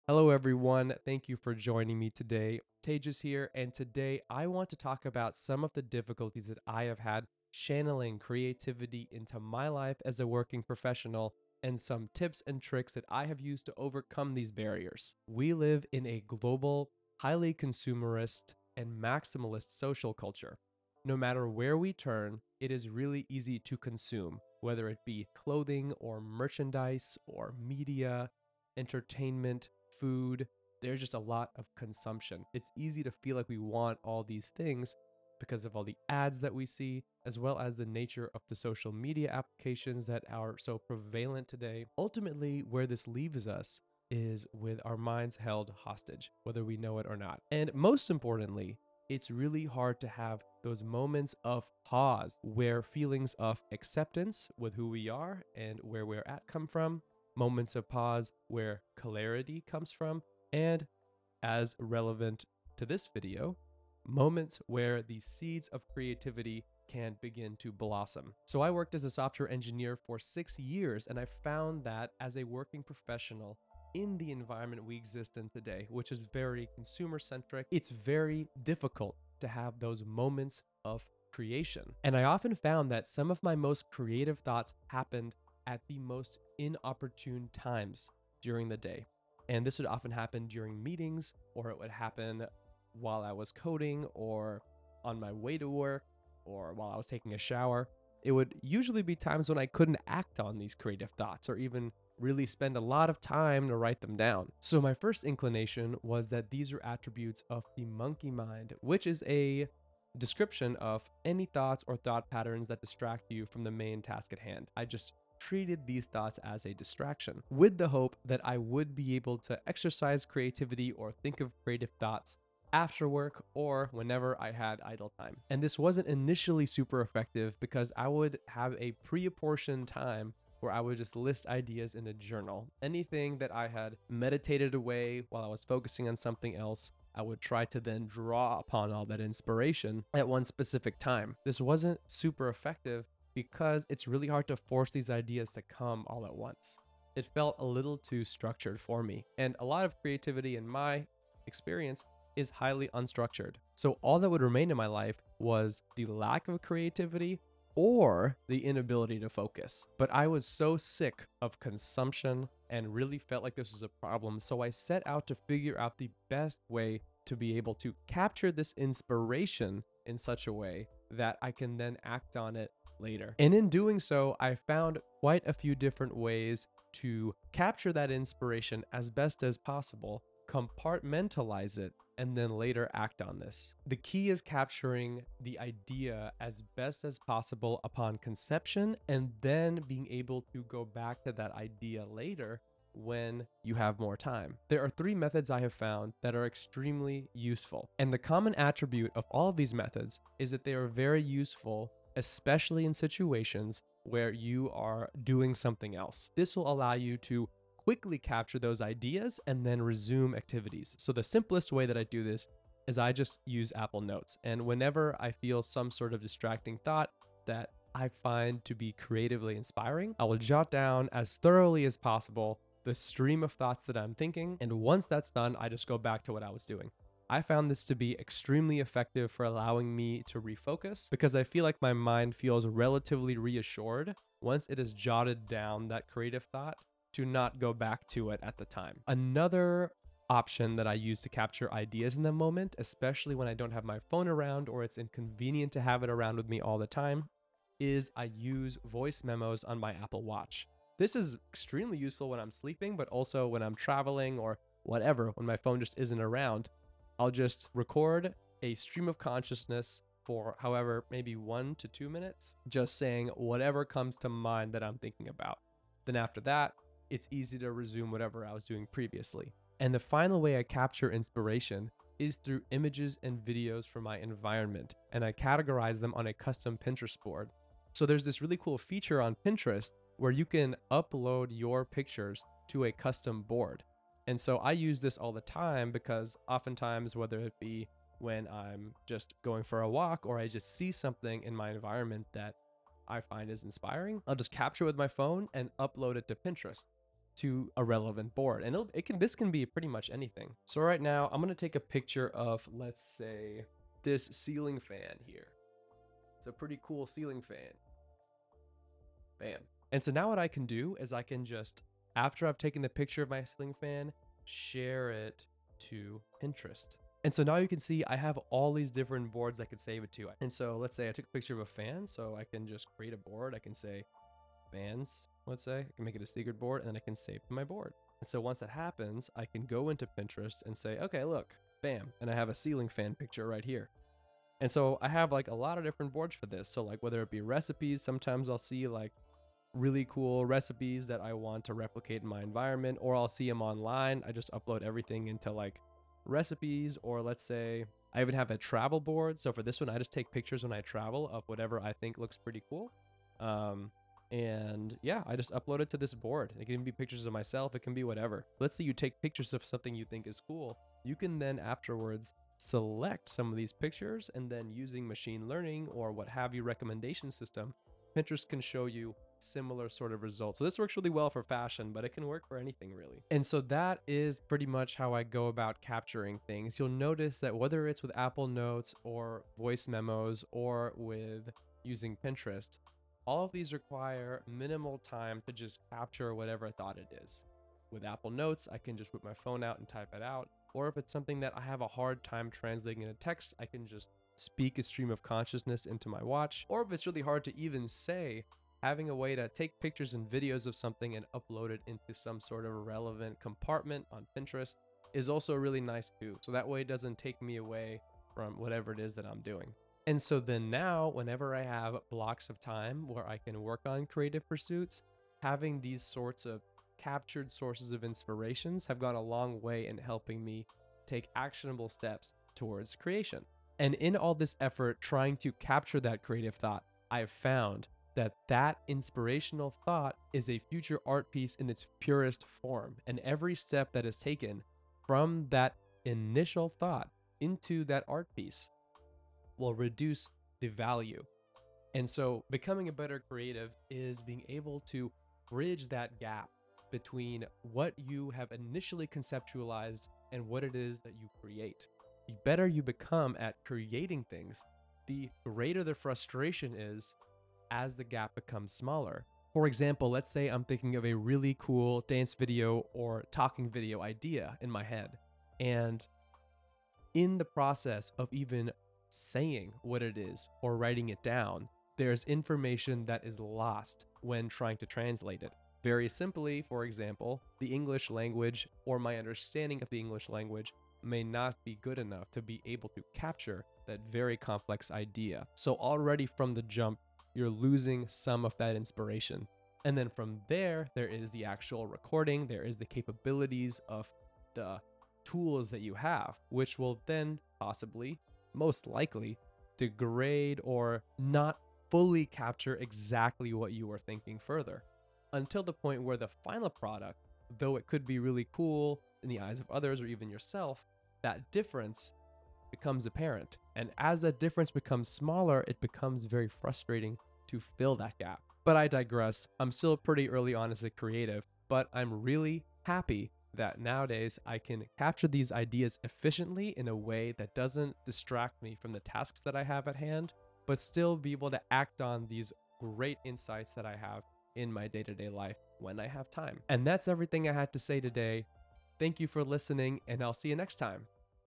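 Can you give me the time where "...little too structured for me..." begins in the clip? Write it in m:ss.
2:27.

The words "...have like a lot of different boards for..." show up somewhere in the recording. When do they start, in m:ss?
5:35.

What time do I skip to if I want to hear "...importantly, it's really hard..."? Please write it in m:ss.
0:48.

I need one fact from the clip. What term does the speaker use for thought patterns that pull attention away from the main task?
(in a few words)
monkey mind.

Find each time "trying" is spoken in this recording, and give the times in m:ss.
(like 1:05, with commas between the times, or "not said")
7:05, 7:54.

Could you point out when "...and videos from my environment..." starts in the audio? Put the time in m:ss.
4:33.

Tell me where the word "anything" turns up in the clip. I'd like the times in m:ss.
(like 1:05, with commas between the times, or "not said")
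2:12, 5:00, 6:12.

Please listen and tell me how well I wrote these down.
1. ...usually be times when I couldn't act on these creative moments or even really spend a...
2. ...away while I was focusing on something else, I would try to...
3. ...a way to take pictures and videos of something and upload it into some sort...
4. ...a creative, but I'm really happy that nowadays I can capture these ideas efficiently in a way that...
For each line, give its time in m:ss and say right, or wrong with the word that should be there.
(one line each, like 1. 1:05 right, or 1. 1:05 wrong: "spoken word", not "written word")
1. 1:38 wrong: "thoughts", not "moments"
2. 2:14 right
3. 6:39 right
4. 8:40 right.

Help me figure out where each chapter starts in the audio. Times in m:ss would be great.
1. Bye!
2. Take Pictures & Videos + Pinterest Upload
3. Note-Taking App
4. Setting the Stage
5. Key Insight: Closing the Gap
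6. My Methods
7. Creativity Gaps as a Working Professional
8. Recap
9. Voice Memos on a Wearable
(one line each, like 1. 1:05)
1. 8:56
2. 4:29
3. 3:31
4. 0:14
5. 7:04
6. 3:15
7. 1:08
8. 6:13
9. 3:58.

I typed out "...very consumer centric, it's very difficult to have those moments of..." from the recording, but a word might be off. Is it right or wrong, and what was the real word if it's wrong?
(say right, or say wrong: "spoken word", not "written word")
right.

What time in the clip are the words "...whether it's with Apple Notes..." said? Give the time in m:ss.
6:17.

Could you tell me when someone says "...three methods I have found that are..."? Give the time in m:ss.
3:14.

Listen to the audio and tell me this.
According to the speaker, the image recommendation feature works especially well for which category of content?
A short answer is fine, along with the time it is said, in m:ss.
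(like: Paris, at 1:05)
fashion, at 6:11.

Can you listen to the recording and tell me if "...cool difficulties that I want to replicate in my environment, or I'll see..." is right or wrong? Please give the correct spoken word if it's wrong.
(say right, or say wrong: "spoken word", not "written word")
wrong: "recipes", not "difficulties".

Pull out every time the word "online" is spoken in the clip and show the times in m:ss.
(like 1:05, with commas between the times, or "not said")
5:43.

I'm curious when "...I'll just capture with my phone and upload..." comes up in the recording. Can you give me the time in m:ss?
4:54.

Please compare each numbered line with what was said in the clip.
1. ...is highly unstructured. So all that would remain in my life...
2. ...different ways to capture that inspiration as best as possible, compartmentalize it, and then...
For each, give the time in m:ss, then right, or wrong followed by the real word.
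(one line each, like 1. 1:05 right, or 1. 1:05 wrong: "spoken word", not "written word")
1. 2:32 right
2. 2:55 right.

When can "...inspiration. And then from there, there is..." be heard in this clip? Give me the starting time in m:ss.
8:08.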